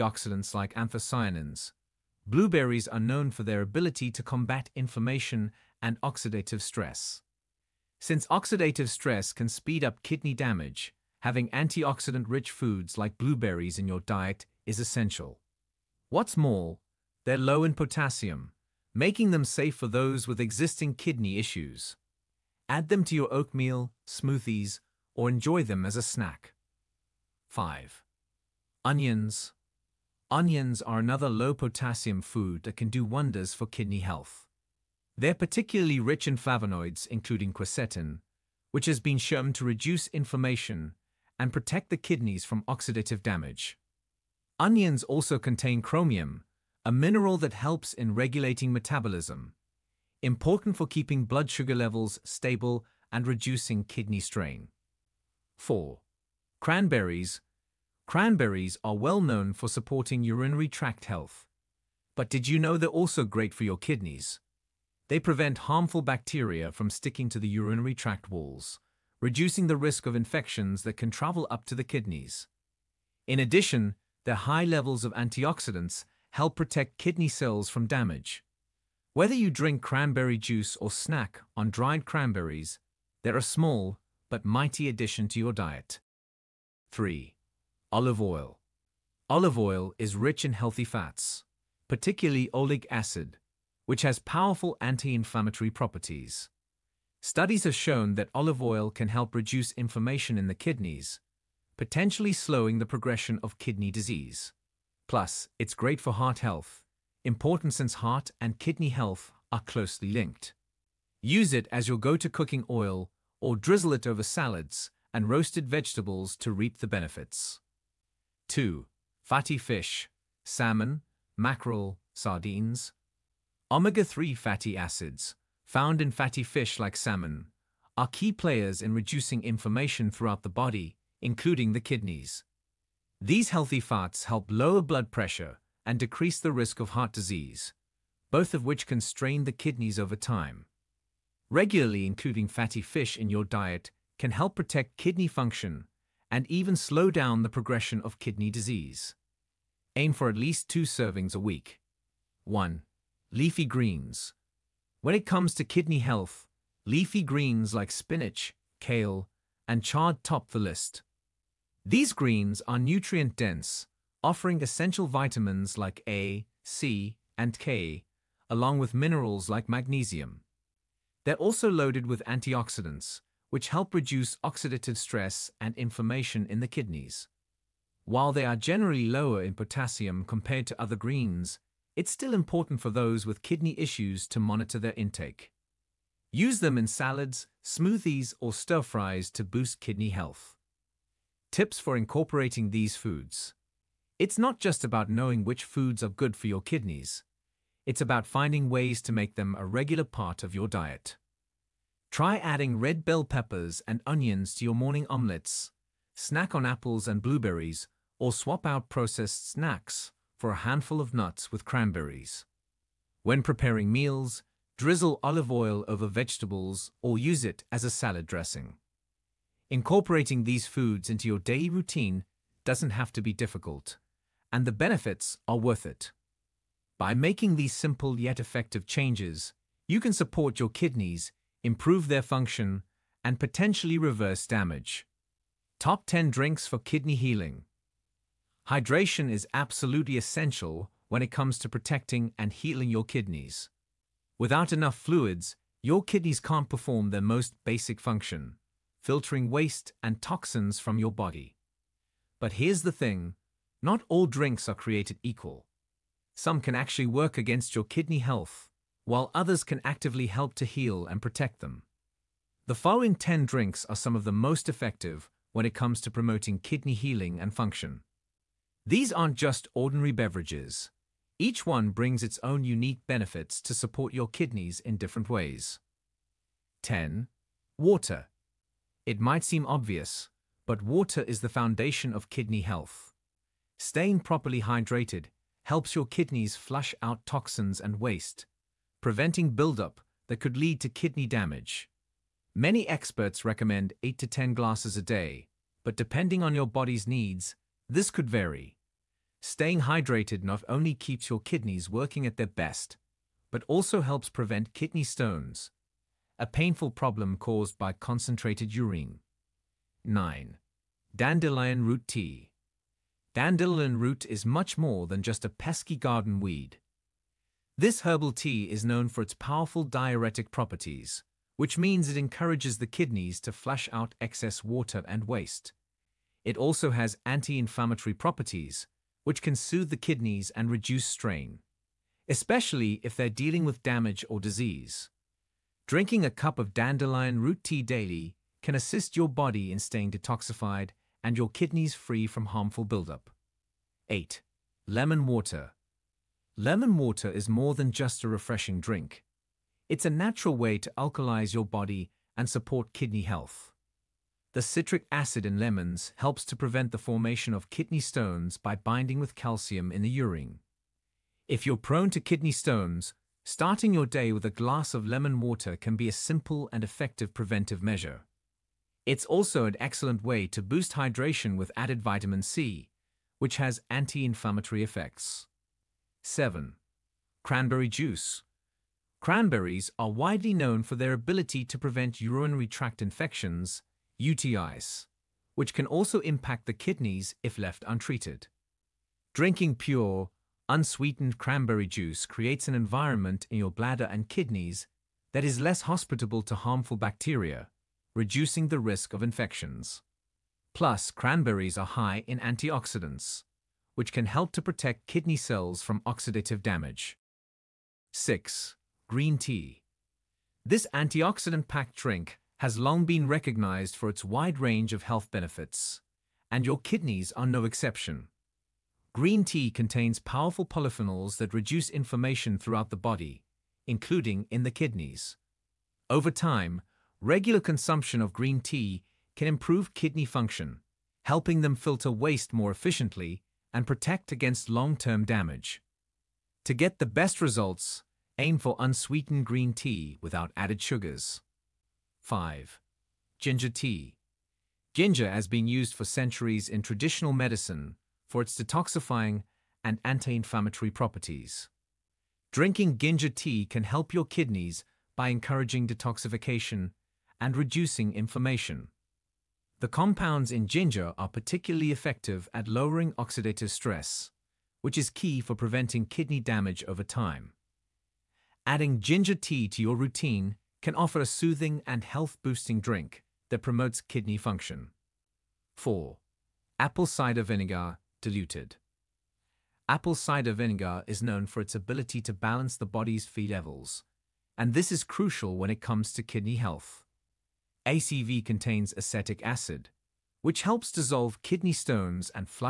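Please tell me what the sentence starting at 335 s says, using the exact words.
Drinking a cup of dandelion root tea daily can assist your body in staying detoxified and your kidneys free from harmful buildup.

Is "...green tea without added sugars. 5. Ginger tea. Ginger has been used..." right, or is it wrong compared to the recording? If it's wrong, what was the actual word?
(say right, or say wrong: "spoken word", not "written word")
right.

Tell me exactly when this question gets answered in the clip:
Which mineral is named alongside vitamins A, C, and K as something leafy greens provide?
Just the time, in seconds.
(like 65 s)
169 s.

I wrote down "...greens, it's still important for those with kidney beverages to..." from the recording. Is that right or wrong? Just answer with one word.
wrong.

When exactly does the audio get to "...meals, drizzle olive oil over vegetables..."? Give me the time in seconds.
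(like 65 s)
213 s.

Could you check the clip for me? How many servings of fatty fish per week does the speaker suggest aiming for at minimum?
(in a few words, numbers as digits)
2.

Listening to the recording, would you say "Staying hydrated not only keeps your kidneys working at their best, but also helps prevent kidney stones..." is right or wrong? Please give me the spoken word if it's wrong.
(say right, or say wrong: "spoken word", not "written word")
right.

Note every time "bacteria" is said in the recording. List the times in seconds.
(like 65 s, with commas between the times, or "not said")
66 s, 396 s.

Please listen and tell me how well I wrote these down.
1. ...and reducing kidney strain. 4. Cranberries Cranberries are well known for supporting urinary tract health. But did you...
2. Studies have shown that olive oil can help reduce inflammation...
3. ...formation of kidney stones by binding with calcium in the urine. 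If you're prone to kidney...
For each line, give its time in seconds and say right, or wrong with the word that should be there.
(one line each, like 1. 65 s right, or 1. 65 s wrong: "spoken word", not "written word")
1. 53 s right
2. 97 s right
3. 356 s right.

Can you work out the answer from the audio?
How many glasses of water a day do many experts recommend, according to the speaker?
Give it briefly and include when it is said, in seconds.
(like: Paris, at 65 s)
8 to 10, at 294 s.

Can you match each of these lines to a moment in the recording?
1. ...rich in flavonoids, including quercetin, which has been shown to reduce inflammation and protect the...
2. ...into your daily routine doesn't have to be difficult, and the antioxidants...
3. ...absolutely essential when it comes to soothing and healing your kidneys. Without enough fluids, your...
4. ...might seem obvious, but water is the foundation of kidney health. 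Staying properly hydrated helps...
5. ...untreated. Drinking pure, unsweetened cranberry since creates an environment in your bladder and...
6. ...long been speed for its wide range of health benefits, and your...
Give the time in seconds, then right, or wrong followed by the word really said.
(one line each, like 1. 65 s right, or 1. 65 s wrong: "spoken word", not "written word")
1. 35 s right
2. 221 s wrong: "benefits", not "antioxidants"
3. 239 s wrong: "protecting", not "soothing"
4. 279 s right
5. 387 s wrong: "juice", not "since"
6. 412 s wrong: "recognized", not "speed".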